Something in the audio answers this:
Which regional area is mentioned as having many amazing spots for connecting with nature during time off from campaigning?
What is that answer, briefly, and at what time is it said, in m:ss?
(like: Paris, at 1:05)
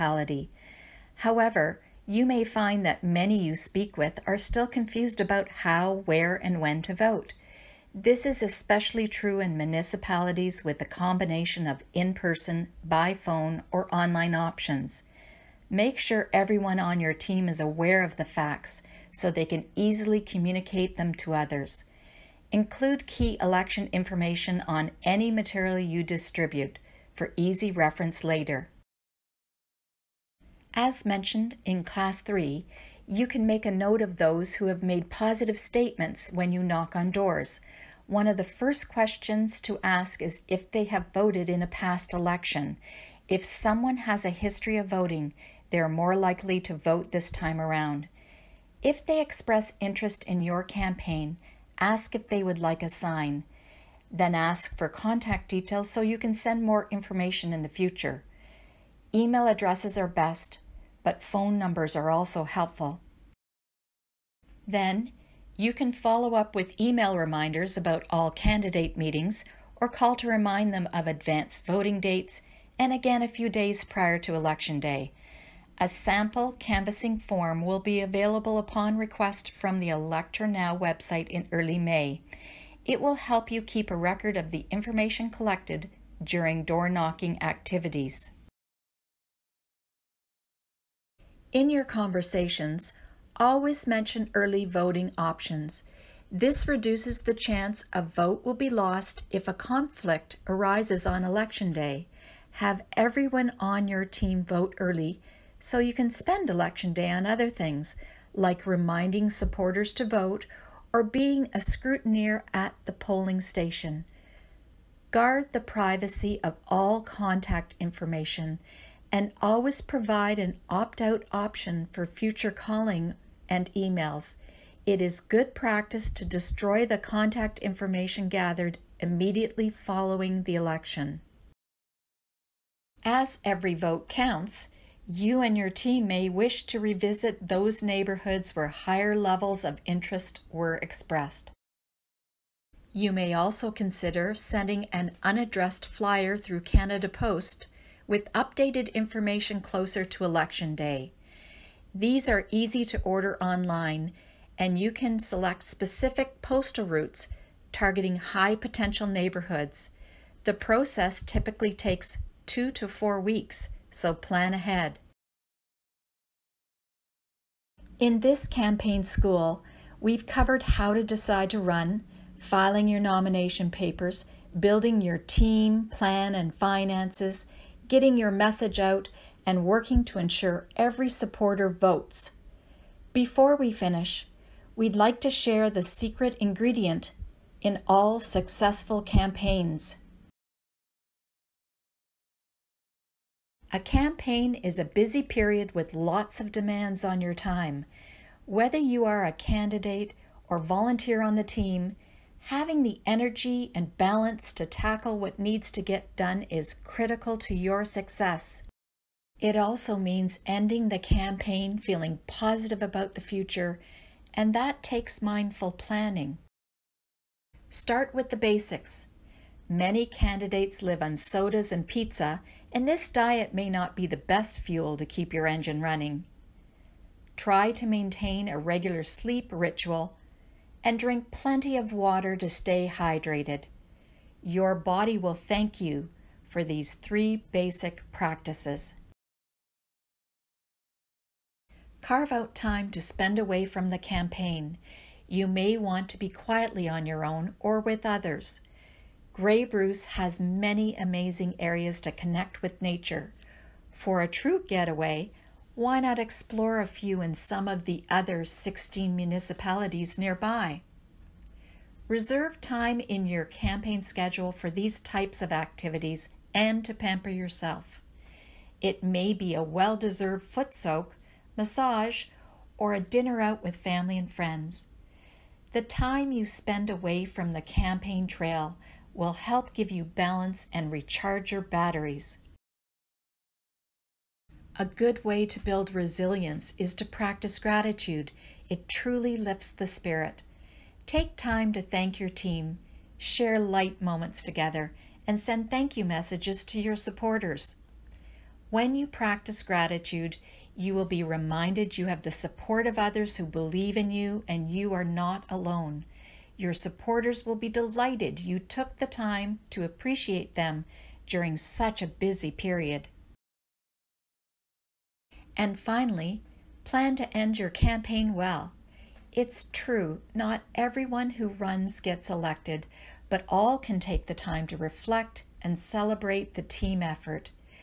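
Grey Bruce, at 4:09.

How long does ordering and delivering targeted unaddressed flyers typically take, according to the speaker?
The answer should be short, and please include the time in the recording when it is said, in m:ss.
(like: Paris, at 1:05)
2 to 4 weeks, at 2:42.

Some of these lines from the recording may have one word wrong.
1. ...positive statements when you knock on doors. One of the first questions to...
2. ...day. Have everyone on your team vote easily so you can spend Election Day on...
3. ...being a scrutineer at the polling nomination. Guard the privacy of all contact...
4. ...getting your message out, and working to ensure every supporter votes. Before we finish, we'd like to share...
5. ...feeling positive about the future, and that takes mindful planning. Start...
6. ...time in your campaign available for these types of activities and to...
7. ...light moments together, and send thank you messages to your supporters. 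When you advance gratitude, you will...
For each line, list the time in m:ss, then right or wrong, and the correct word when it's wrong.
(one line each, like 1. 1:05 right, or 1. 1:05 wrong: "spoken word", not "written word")
1. 0:35 right
2. 1:41 wrong: "early", not "easily"
3. 1:51 wrong: "station", not "nomination"
4. 2:57 right
5. 3:31 right
6. 4:22 wrong: "schedule", not "available"
7. 4:53 wrong: "practice", not "advance".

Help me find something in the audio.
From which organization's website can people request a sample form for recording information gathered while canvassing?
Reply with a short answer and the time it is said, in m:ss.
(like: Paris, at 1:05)
electHER Now, at 1:19.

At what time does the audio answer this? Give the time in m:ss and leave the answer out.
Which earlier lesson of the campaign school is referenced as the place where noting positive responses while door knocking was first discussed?
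0:31.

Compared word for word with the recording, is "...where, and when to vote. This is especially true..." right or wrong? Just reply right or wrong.
right.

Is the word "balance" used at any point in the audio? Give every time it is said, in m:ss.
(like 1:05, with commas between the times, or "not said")
3:23, 4:40.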